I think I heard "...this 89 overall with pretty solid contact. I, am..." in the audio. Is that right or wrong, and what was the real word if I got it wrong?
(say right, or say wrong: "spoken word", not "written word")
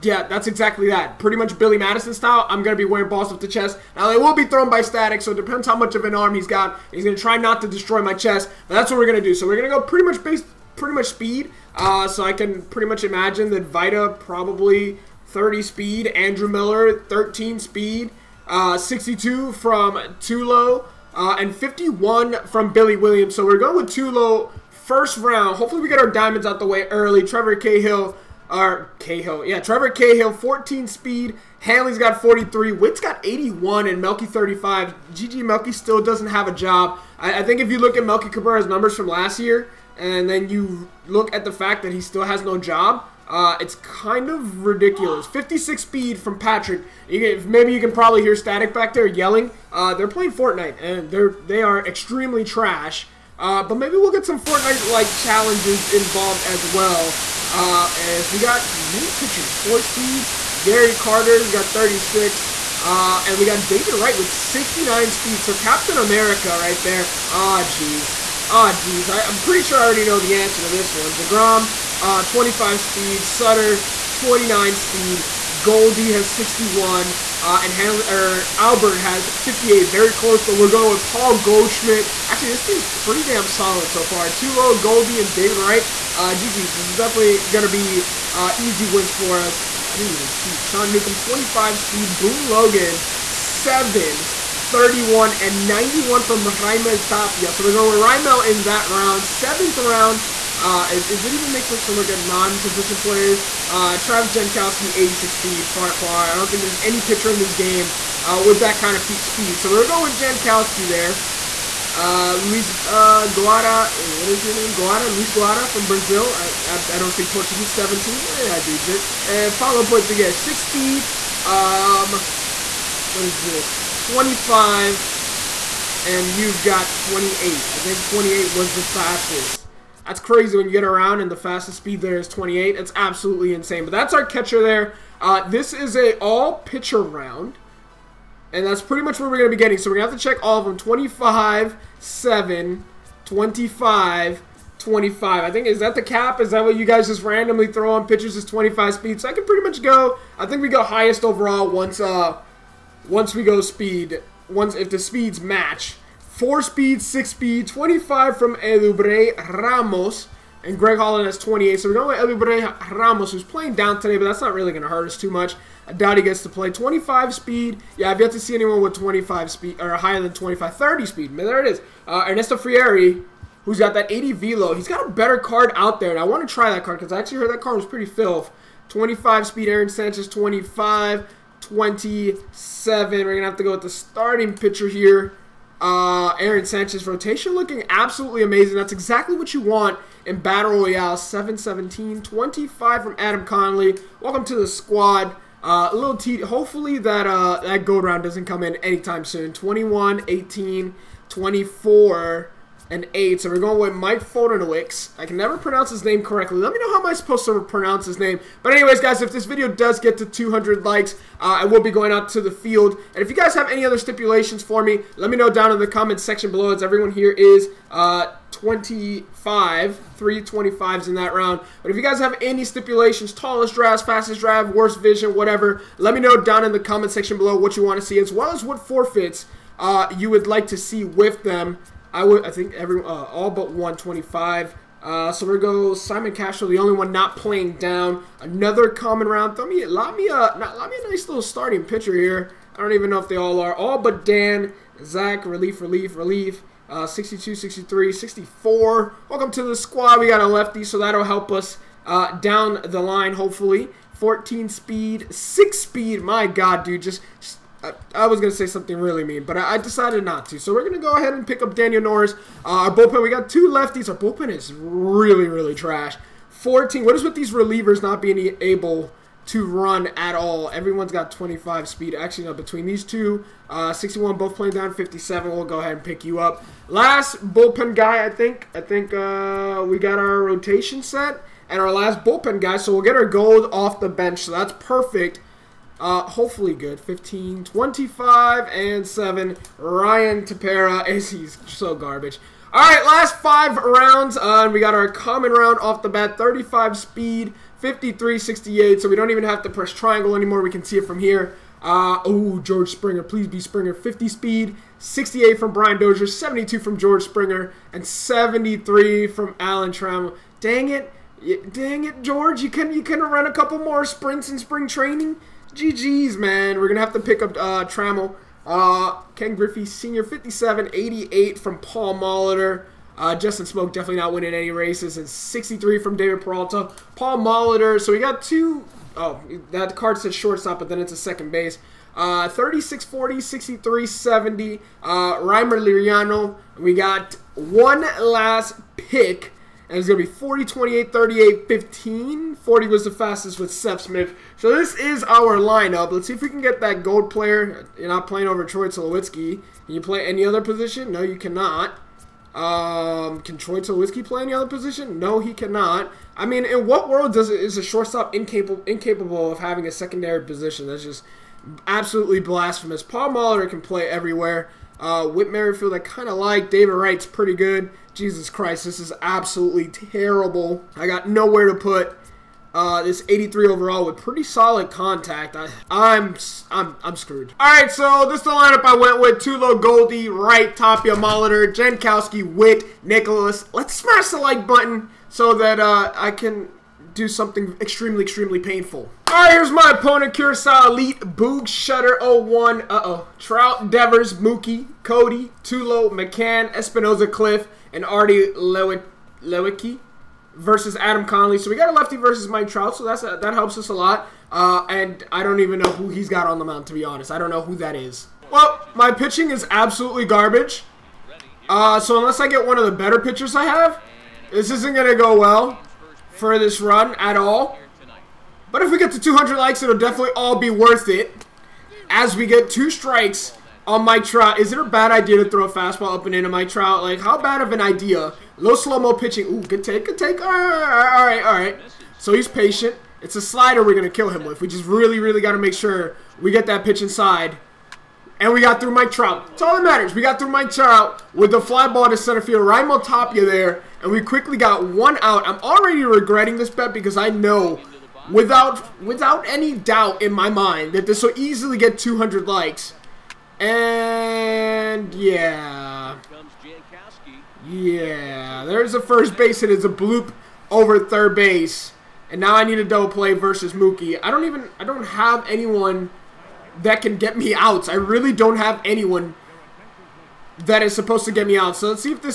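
wrong: "83", not "89".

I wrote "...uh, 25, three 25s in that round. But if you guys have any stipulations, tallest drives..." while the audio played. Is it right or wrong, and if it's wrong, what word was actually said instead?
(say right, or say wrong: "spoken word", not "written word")
right.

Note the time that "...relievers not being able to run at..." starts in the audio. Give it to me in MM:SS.
04:27.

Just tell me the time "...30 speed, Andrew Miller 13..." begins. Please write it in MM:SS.
00:15.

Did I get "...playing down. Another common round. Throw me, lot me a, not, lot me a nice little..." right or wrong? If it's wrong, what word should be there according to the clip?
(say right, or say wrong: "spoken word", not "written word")
right.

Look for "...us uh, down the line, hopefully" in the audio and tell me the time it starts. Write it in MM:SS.
04:11.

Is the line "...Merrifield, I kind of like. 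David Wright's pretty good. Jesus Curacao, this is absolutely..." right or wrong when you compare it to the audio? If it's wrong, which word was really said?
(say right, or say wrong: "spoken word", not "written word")
wrong: "Christ", not "Curacao".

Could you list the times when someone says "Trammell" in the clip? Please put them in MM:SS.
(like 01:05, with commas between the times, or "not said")
05:09, 05:17.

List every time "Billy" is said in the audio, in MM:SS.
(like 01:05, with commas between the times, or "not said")
00:01, 00:22.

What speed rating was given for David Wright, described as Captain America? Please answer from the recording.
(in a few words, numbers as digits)
69.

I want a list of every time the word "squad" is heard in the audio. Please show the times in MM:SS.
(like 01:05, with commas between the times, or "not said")
03:14, 04:09.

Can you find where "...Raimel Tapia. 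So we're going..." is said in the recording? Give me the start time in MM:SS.
01:36.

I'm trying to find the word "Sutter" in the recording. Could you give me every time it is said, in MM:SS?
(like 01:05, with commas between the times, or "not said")
01:13.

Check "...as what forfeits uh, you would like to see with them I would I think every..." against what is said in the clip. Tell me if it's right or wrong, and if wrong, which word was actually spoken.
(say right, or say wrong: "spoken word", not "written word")
right.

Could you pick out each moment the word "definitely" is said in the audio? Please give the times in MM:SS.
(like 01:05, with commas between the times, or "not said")
01:26, 05:23, 06:59.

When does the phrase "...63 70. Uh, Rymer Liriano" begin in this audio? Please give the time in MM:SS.
05:33.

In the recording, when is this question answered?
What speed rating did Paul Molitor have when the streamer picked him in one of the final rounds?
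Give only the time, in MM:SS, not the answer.
05:20.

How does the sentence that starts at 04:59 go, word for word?
So we don't even have to press triangle anymore.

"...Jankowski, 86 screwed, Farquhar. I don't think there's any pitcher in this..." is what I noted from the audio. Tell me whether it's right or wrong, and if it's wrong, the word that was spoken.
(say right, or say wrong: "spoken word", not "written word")
wrong: "speed", not "screwed".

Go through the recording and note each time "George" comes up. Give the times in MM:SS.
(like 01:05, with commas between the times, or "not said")
05:02, 05:06, 05:12.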